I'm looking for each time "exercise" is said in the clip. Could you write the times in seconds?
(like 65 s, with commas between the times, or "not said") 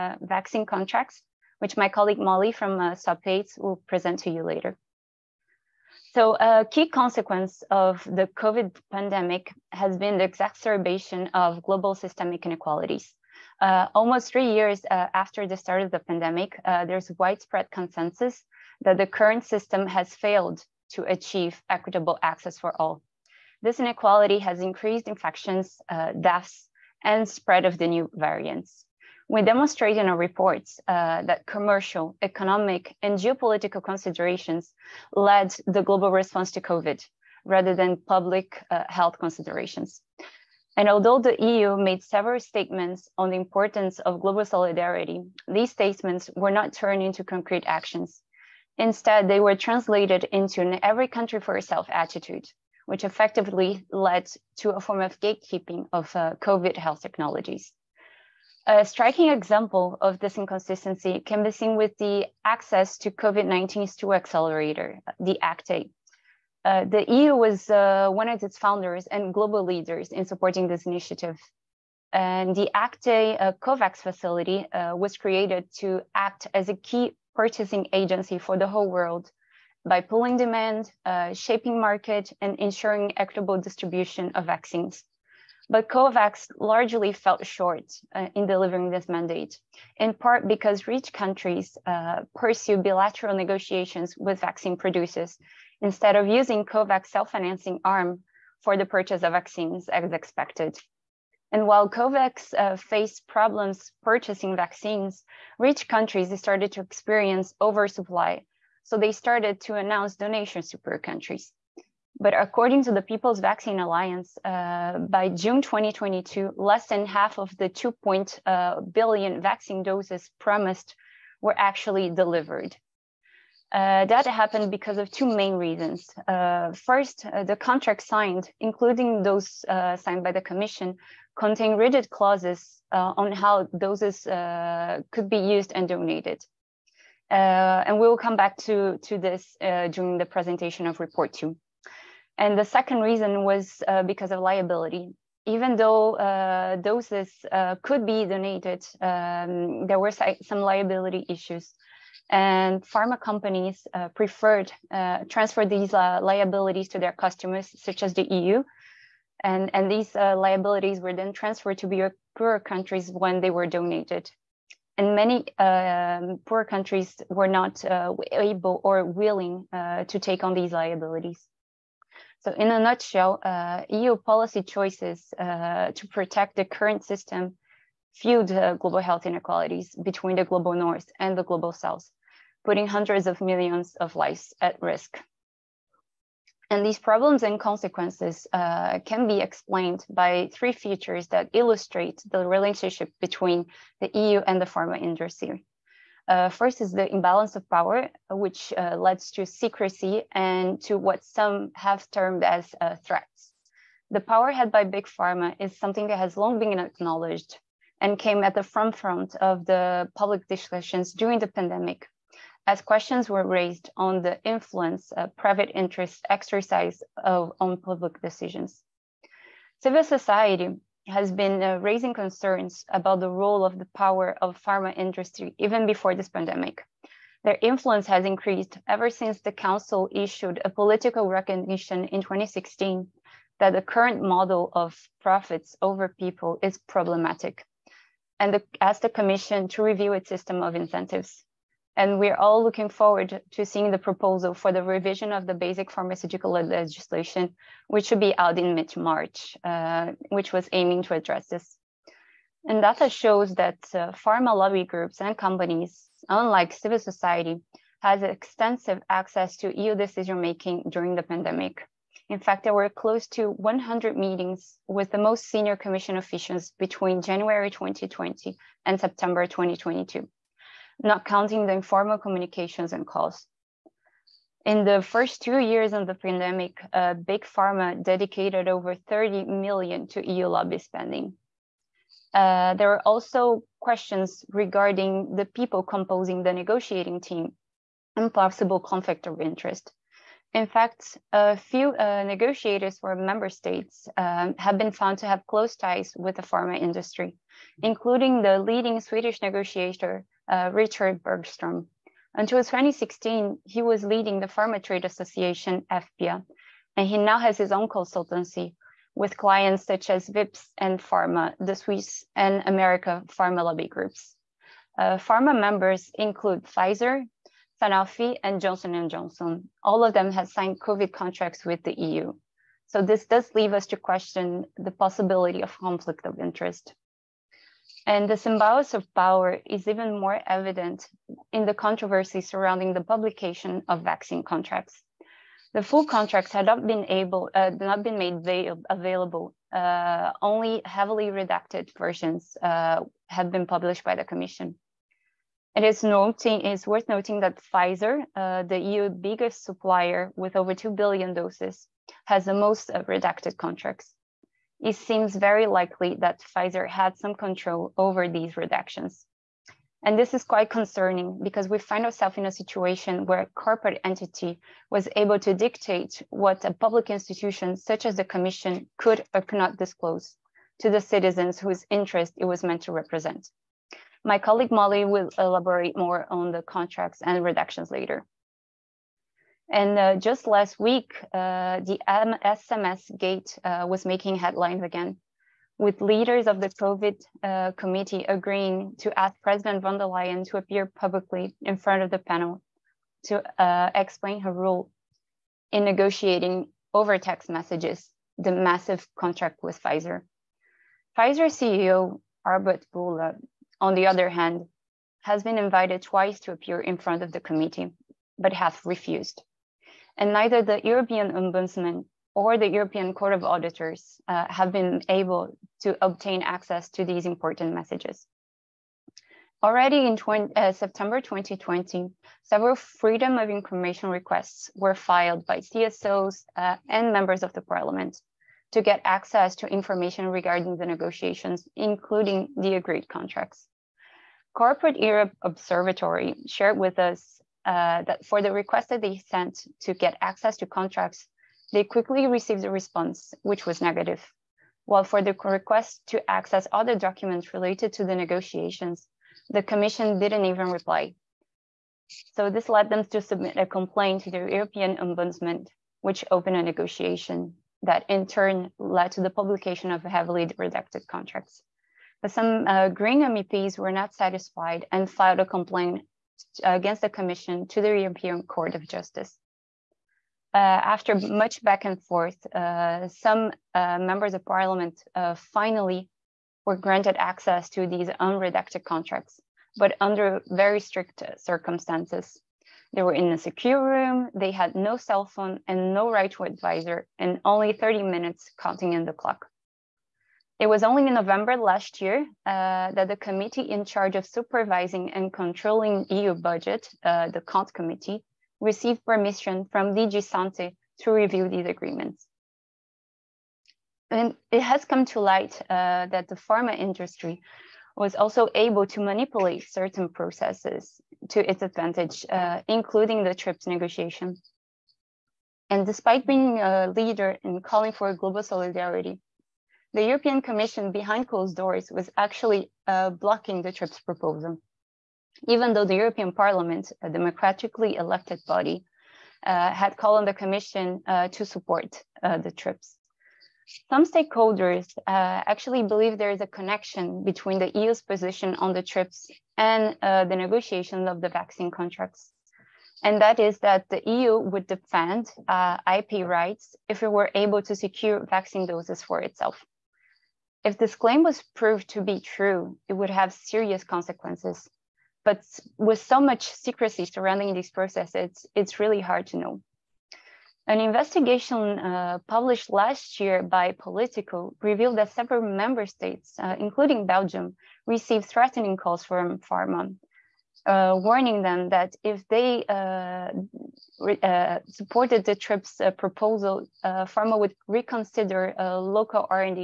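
216 s.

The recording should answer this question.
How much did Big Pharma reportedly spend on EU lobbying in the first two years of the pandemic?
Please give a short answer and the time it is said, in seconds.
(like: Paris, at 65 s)
over 30 million, at 278 s.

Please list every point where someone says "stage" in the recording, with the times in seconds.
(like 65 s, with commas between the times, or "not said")
not said.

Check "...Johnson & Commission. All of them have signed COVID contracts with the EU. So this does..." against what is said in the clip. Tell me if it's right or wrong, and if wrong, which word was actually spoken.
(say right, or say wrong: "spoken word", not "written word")
wrong: "Johnson", not "Commission".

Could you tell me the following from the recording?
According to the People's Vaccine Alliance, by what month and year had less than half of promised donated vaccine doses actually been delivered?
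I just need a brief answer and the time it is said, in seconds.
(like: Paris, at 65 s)
June 2022, at 115 s.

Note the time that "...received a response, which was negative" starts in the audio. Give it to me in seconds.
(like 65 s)
442 s.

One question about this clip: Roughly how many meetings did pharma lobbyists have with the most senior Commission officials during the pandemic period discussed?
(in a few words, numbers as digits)
close to 100.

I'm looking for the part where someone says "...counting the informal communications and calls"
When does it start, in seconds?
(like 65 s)
271 s.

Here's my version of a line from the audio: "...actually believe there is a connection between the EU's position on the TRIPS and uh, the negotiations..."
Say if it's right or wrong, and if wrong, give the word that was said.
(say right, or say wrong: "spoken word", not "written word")
right.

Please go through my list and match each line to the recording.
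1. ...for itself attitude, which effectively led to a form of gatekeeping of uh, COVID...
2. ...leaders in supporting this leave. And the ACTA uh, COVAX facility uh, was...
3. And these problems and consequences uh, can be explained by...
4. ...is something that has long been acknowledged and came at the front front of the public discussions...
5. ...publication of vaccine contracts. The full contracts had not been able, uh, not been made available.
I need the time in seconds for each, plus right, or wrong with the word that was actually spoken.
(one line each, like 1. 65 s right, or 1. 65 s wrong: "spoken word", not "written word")
1. 51 s right
2. 69 s wrong: "initiative", not "leave"
3. 186 s right
4. 205 s right
5. 333 s right.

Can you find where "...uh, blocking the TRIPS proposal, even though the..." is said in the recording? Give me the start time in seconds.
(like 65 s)
522 s.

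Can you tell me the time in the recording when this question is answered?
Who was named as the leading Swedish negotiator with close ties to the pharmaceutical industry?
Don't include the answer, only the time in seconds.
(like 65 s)
300 s.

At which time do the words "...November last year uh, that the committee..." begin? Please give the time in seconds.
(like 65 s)
491 s.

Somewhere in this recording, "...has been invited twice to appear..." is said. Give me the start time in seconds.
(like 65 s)
405 s.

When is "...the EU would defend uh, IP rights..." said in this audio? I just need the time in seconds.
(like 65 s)
543 s.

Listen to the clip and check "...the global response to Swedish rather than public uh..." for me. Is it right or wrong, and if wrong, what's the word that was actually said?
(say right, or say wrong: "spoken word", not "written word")
wrong: "COVID", not "Swedish".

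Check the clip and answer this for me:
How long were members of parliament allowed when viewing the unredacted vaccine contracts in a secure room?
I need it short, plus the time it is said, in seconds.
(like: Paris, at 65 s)
30 minutes, at 487 s.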